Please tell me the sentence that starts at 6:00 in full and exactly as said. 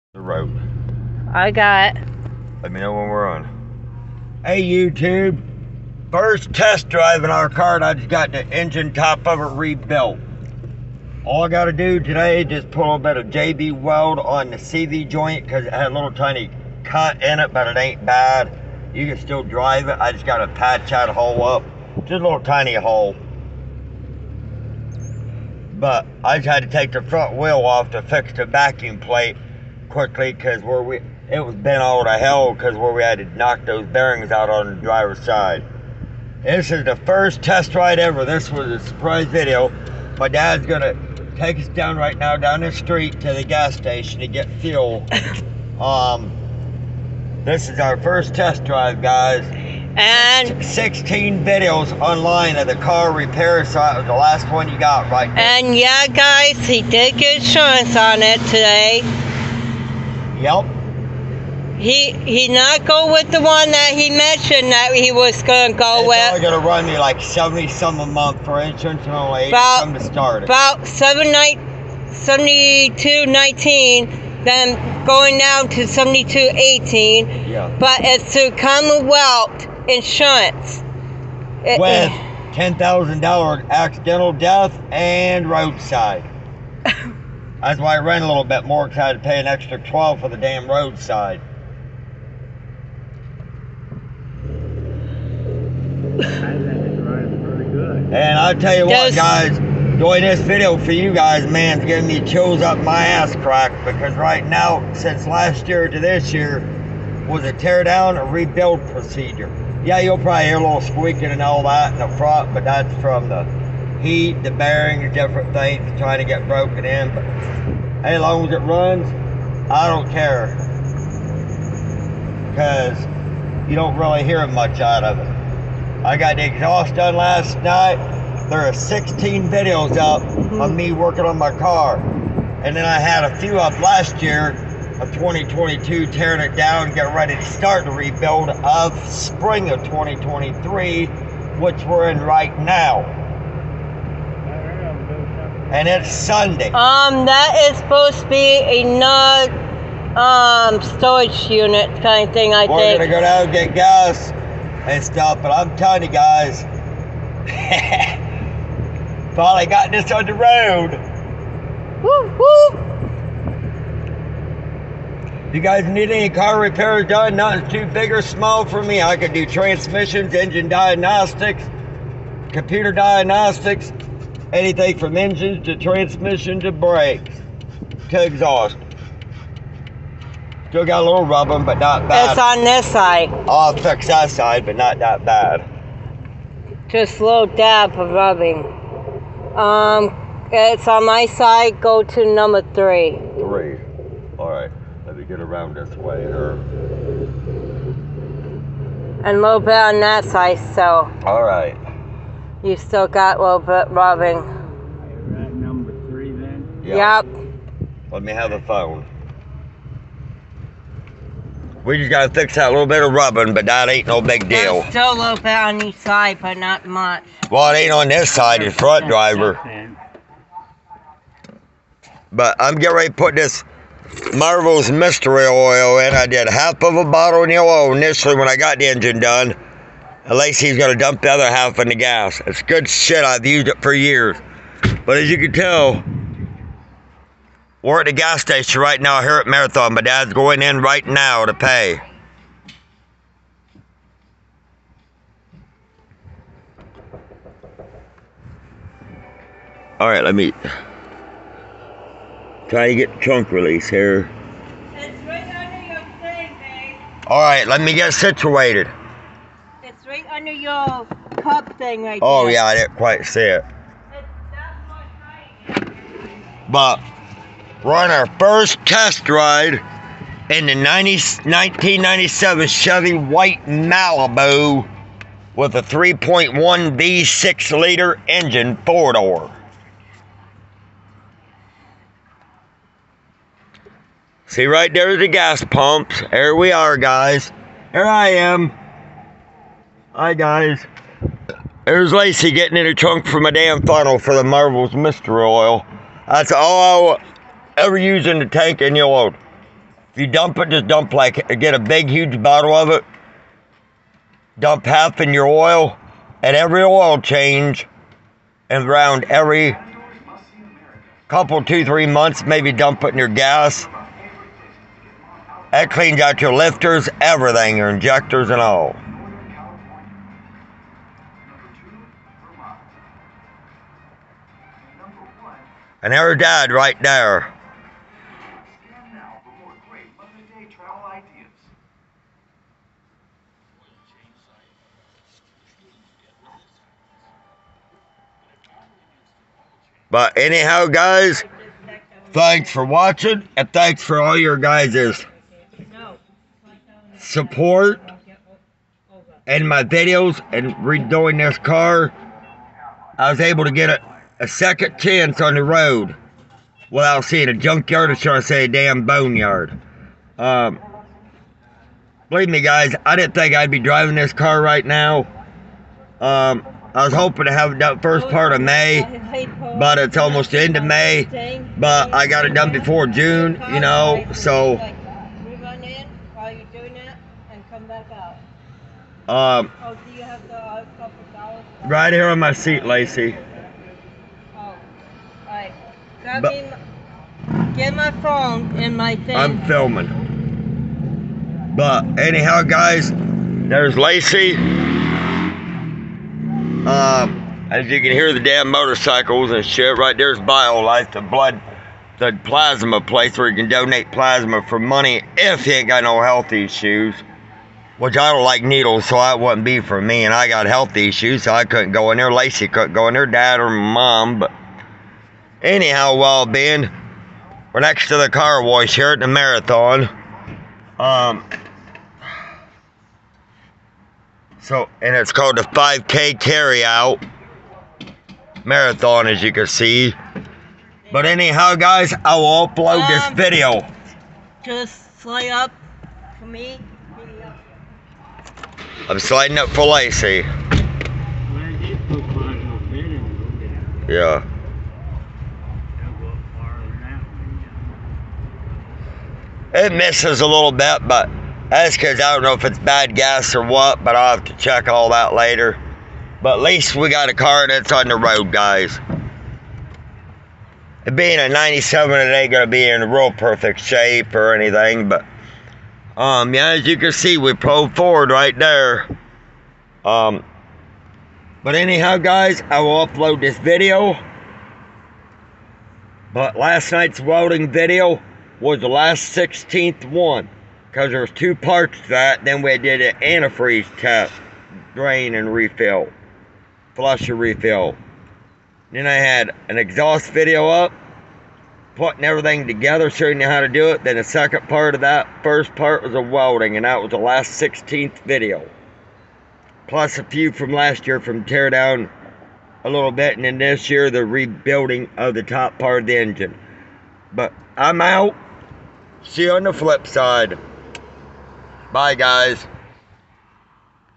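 Um, believe me, guys, I didn't think I'd be driving this car right now.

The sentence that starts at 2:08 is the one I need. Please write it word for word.
There are 16 videos up mm-hmm.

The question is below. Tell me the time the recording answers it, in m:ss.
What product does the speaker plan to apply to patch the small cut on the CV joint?
0:13.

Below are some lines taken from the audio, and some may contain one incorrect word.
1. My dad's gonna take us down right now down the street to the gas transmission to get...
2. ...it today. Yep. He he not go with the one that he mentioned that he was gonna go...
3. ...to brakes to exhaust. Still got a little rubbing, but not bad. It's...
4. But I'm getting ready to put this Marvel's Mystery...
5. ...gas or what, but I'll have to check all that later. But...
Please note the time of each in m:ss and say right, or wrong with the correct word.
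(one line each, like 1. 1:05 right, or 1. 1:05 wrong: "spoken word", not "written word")
1. 0:40 wrong: "station", not "transmission"
2. 0:58 right
3. 2:56 right
4. 3:42 right
5. 7:33 right.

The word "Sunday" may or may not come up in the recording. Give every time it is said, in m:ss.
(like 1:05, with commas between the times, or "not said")
2:26.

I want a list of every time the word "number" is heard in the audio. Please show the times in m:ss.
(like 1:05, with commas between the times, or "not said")
3:12, 3:25.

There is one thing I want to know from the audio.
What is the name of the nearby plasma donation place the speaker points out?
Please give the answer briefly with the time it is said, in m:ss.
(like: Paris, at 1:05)
BioLife, at 6:40.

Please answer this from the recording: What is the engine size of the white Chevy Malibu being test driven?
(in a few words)
3.1 V6.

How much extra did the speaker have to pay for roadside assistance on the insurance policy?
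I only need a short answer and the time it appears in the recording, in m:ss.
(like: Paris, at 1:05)
12, at 1:29.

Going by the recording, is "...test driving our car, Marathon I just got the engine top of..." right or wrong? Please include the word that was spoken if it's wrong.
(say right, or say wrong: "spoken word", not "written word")
wrong: "And", not "Marathon".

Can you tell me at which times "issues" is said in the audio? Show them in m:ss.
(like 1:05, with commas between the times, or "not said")
6:46, 6:50.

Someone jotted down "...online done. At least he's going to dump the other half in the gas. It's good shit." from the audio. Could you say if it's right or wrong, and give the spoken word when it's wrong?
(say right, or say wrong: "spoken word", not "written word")
wrong: "engine", not "online".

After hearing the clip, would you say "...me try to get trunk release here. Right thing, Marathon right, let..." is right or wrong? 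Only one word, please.
wrong.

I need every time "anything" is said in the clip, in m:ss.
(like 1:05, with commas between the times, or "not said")
2:54, 7:44.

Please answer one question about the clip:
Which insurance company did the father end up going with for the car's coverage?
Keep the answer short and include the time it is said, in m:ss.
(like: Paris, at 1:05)
Commonwealth Insurance, at 1:18.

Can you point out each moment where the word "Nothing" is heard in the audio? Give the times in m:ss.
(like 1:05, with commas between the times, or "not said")
2:47.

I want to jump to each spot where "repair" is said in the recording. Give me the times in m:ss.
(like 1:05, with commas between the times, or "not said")
0:53, 2:46.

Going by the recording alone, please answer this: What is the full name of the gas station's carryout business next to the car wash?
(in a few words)
5K Carryout Marathon.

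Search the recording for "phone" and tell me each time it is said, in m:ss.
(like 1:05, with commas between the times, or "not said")
3:28, 6:28.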